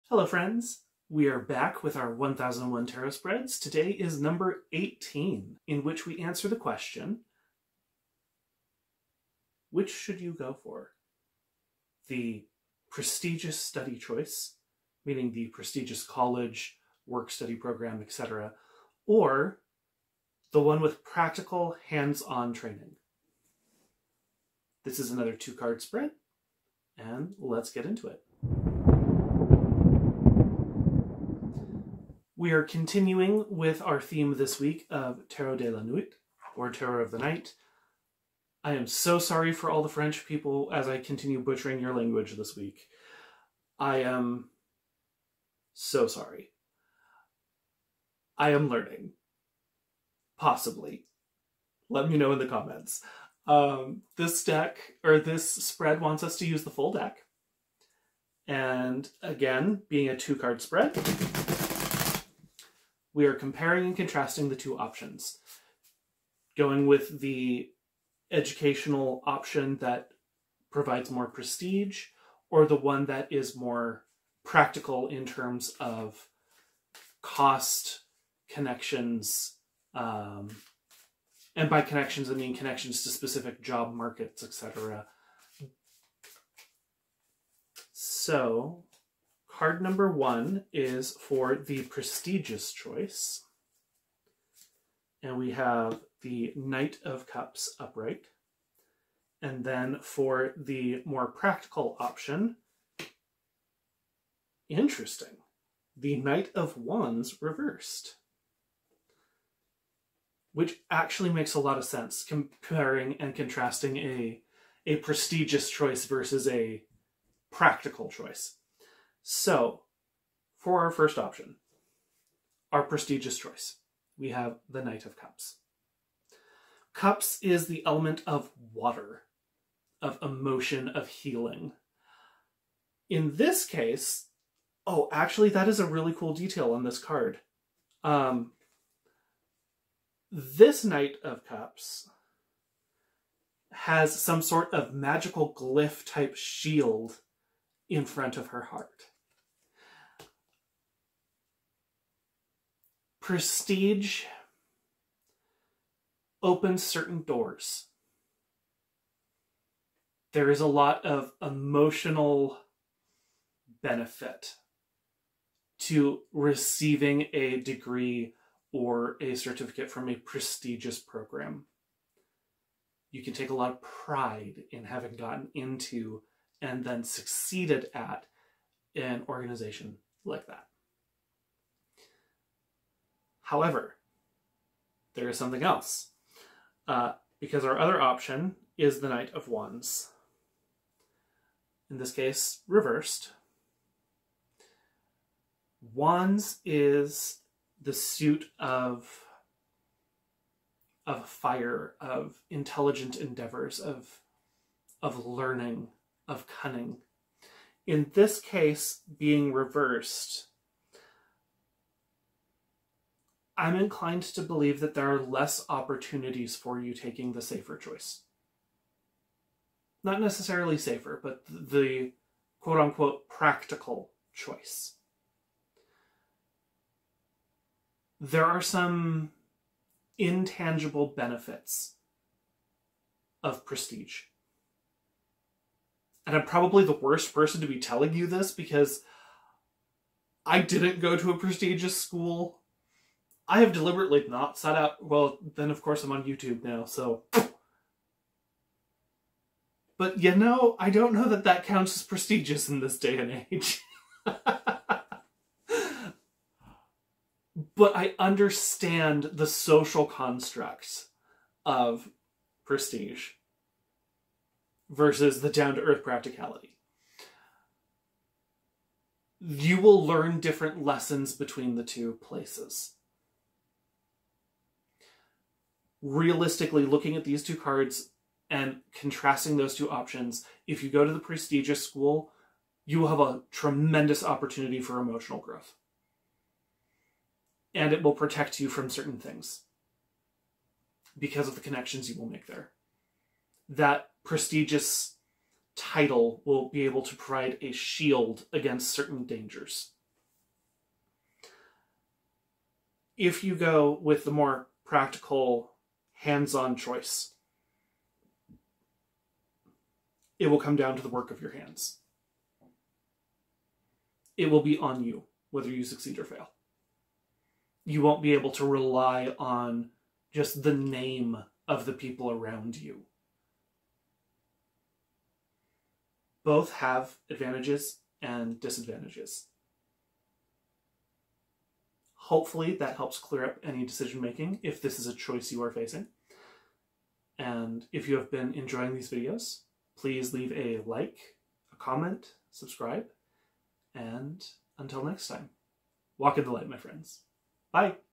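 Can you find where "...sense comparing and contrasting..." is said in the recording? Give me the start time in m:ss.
1:51.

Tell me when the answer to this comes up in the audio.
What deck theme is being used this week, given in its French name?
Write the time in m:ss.
0:35.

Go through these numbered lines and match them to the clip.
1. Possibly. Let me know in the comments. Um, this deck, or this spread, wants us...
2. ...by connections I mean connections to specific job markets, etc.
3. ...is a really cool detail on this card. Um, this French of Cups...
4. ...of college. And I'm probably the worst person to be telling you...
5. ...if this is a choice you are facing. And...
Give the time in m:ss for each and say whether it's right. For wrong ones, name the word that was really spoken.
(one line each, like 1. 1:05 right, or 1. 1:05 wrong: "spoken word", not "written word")
1. 0:50 right
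2. 1:21 right
3. 2:15 wrong: "Knight", not "French"
4. 3:53 wrong: "prestige", not "college"
5. 5:34 right.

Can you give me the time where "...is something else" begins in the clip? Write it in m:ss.
3:05.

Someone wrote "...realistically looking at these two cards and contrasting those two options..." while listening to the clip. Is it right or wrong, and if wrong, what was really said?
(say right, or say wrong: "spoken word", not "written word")
right.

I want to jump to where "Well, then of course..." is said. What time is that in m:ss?
4:05.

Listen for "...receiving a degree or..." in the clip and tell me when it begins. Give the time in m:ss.
2:46.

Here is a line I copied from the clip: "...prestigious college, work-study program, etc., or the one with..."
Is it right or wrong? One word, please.
right.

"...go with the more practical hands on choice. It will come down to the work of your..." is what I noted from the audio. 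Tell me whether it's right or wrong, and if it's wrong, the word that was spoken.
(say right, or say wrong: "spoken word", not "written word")
right.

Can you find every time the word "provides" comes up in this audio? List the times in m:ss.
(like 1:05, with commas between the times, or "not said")
1:10, 4:57.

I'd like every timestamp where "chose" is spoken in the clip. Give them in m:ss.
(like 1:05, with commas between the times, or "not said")
not said.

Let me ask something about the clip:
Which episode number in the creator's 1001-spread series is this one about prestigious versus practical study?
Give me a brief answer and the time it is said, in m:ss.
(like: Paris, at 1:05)
18, at 0:04.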